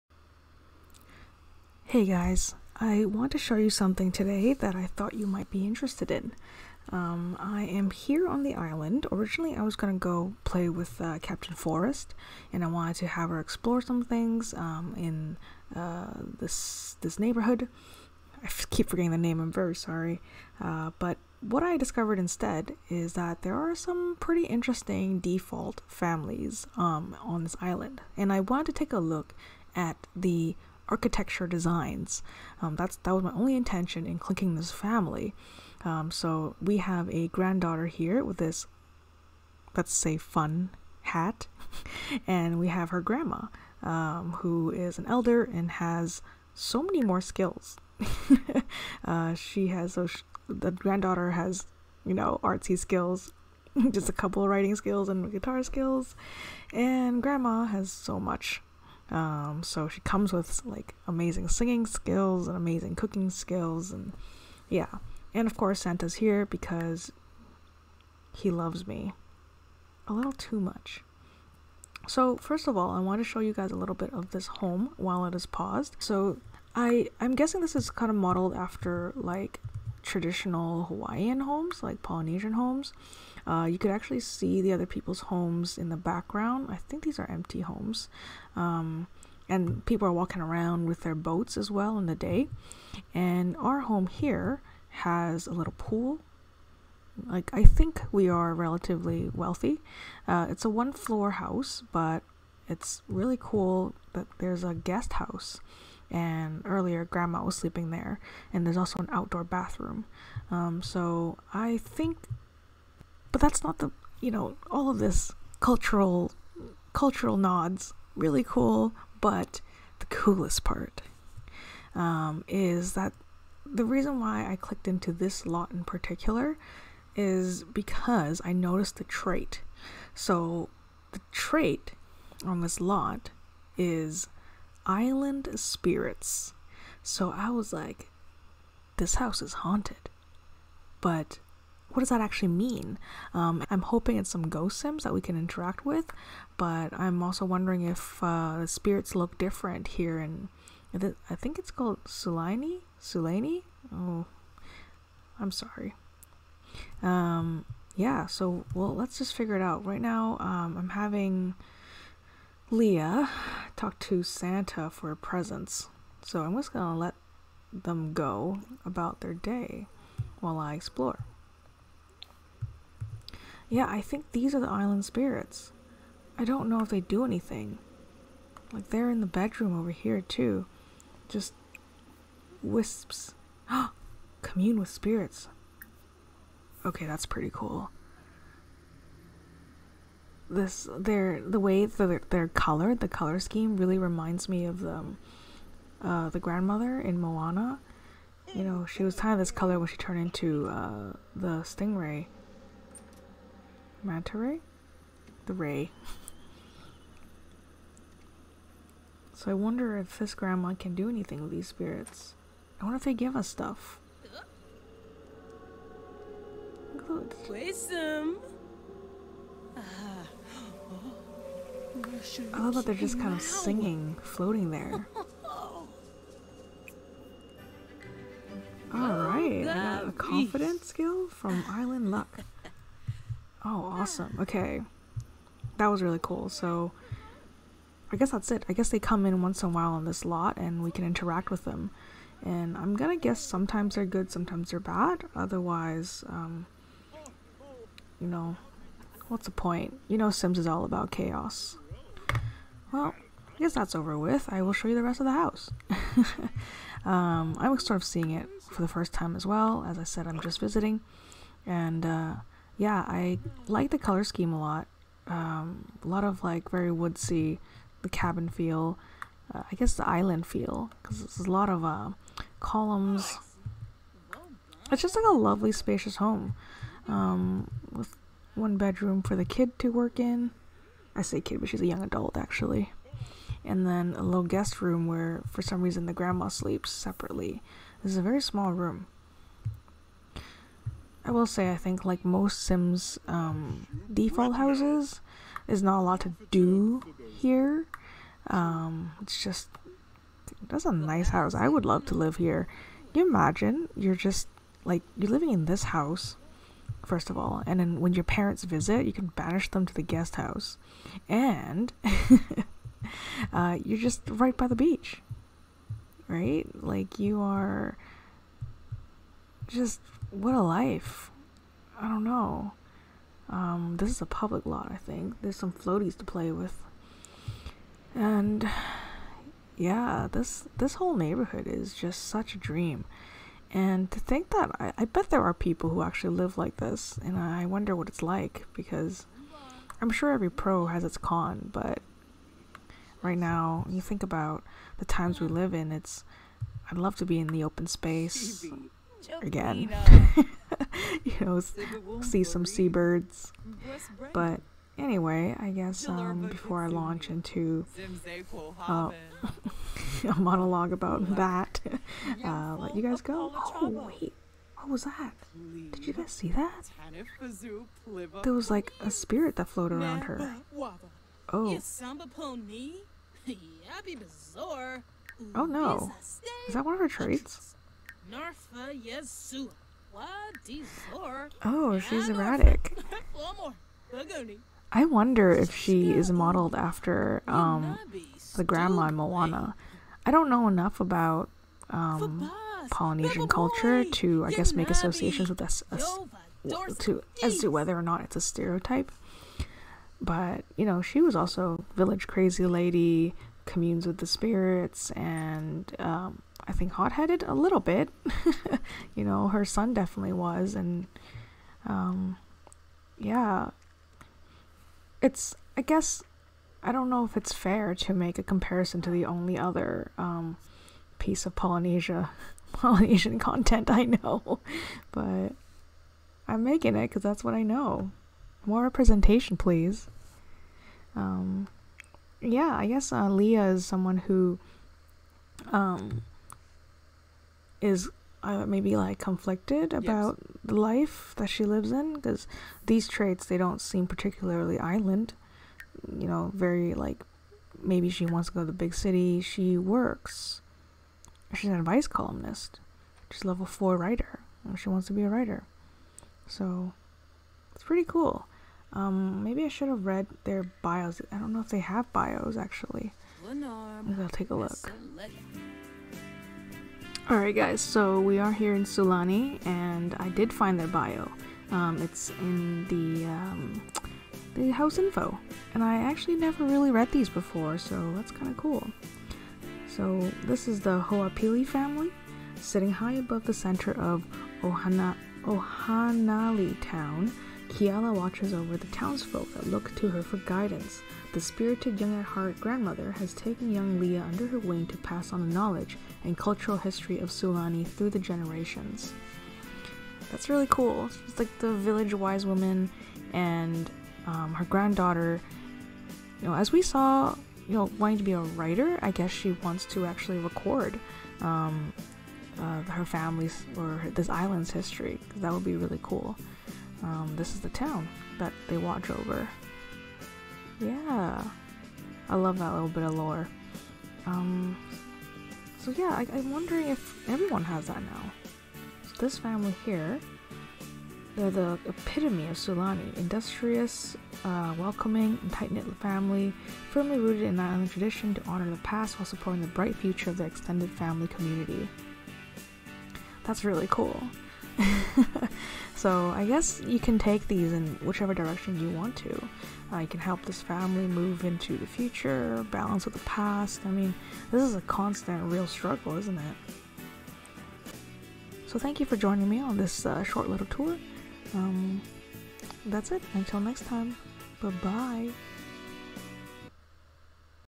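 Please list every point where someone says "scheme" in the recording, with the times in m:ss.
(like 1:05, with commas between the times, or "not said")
3:13, 4:24.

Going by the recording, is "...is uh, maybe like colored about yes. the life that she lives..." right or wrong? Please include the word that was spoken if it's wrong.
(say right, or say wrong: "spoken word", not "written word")
wrong: "conflicted", not "colored".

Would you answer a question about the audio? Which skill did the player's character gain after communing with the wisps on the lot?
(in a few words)
Confidence.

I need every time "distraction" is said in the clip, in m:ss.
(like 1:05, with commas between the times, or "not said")
not said.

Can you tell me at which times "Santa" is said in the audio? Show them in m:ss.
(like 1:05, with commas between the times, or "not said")
1:05, 2:44.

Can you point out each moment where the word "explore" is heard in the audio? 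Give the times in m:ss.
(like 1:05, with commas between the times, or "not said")
0:13, 2:50.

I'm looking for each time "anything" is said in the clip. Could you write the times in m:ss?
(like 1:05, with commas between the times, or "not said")
2:57, 3:31.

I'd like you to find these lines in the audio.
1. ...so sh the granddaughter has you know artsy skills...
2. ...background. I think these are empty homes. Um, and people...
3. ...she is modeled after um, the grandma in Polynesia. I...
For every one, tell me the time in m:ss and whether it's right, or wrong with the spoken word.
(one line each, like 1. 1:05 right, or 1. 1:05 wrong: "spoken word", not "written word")
1. 0:49 right
2. 1:25 right
3. 6:25 wrong: "Moana", not "Polynesia".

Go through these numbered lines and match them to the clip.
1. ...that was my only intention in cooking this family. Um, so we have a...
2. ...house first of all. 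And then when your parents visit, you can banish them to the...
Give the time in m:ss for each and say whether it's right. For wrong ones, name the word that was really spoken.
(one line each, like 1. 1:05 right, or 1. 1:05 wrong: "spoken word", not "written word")
1. 0:32 wrong: "clicking", not "cooking"
2. 5:05 right.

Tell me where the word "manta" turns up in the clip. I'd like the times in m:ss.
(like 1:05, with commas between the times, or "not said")
3:24.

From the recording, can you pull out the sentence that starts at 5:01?
I would love to live here.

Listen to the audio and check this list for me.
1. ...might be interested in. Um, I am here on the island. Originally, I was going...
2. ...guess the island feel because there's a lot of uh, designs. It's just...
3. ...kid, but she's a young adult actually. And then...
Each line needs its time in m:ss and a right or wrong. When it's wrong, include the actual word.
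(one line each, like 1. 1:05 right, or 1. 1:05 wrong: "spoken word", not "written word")
1. 0:05 right
2. 4:29 wrong: "columns", not "designs"
3. 4:41 right.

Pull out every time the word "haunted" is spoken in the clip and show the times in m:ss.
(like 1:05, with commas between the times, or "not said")
2:19.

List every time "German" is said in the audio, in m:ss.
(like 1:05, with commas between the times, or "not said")
not said.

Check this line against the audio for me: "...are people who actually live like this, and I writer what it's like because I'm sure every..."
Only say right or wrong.
wrong.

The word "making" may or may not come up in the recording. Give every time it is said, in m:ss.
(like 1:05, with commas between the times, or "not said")
7:06.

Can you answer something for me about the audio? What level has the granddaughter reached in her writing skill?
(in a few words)
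4.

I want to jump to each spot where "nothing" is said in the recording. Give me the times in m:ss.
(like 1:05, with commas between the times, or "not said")
not said.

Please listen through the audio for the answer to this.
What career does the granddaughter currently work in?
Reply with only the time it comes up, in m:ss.
7:31.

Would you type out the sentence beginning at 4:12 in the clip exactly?
Well, I guess that's over with.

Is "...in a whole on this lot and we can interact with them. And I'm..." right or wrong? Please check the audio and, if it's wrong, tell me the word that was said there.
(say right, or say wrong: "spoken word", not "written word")
wrong: "while", not "whole".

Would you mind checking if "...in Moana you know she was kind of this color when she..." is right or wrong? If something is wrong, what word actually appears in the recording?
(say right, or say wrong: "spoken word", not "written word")
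right.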